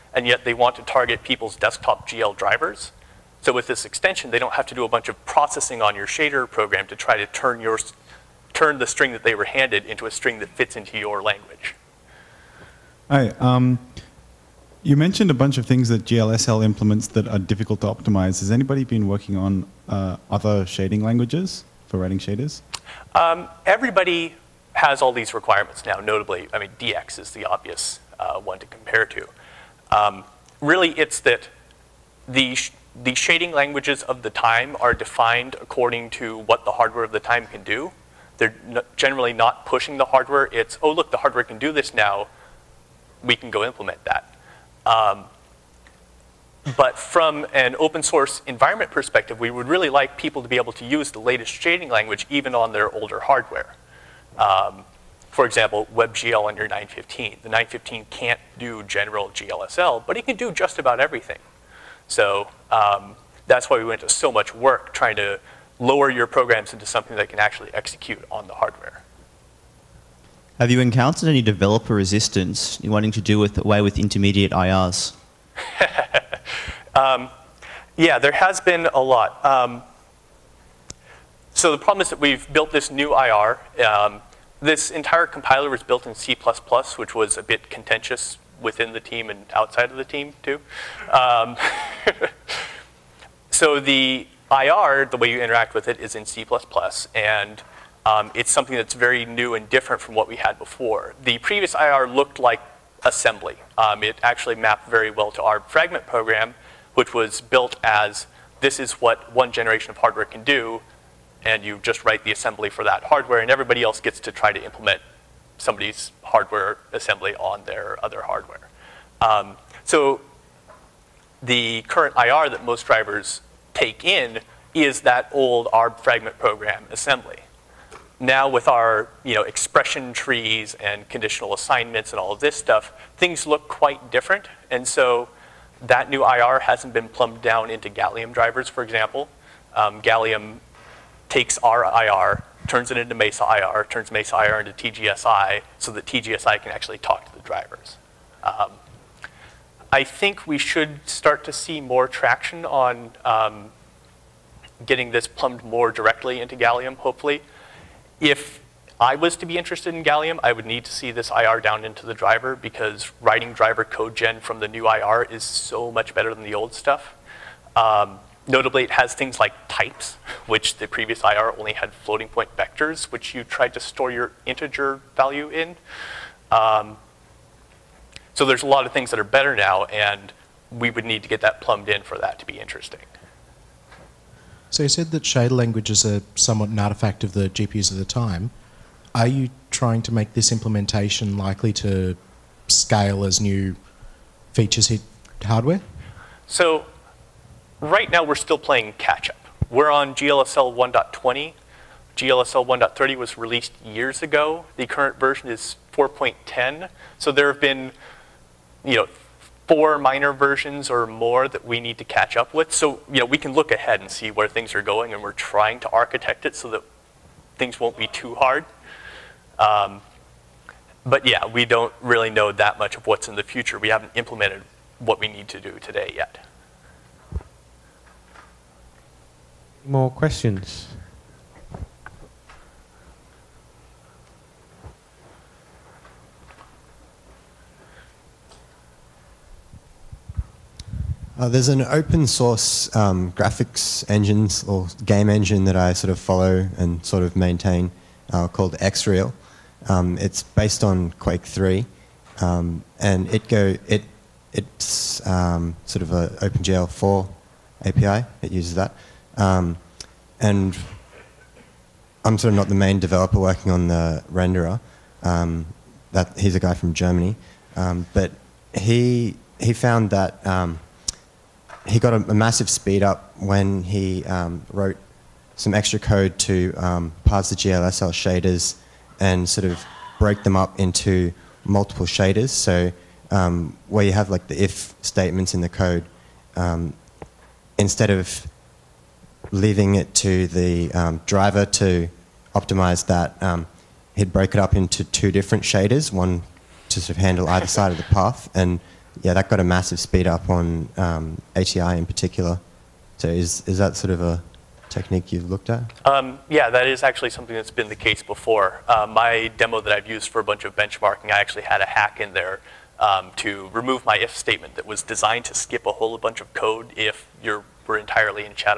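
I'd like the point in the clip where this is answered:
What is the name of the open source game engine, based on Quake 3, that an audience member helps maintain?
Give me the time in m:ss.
4:08.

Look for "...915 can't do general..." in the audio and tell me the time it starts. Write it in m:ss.
0:57.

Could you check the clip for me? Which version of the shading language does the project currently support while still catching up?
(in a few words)
GLSL 1.20.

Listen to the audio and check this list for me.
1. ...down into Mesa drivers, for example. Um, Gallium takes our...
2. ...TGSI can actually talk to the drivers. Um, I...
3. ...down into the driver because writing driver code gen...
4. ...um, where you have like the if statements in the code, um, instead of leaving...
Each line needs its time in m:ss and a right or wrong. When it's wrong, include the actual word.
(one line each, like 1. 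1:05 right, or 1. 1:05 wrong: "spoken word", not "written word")
1. 2:17 wrong: "Gallium", not "Mesa"
2. 2:26 right
3. 2:41 right
4. 4:43 right.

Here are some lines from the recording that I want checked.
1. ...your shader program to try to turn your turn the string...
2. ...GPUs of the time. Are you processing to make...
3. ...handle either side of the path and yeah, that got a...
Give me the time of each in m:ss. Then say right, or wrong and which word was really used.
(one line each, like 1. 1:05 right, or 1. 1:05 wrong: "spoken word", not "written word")
1. 0:05 right
2. 3:07 wrong: "trying", not "processing"
3. 4:57 right.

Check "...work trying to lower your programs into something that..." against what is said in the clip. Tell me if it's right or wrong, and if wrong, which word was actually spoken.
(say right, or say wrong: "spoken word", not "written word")
right.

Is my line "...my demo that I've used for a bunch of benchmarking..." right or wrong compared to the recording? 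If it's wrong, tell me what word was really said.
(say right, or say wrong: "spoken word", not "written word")
right.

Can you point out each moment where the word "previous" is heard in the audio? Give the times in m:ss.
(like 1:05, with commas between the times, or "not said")
1:41, 2:50.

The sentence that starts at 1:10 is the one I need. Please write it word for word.
Have you encountered any developer resistance in wanting to do with, away with intermediate IRs?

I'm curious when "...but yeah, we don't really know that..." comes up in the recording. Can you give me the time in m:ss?
3:41.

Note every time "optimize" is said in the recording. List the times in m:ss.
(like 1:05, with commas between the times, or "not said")
0:17, 4:52.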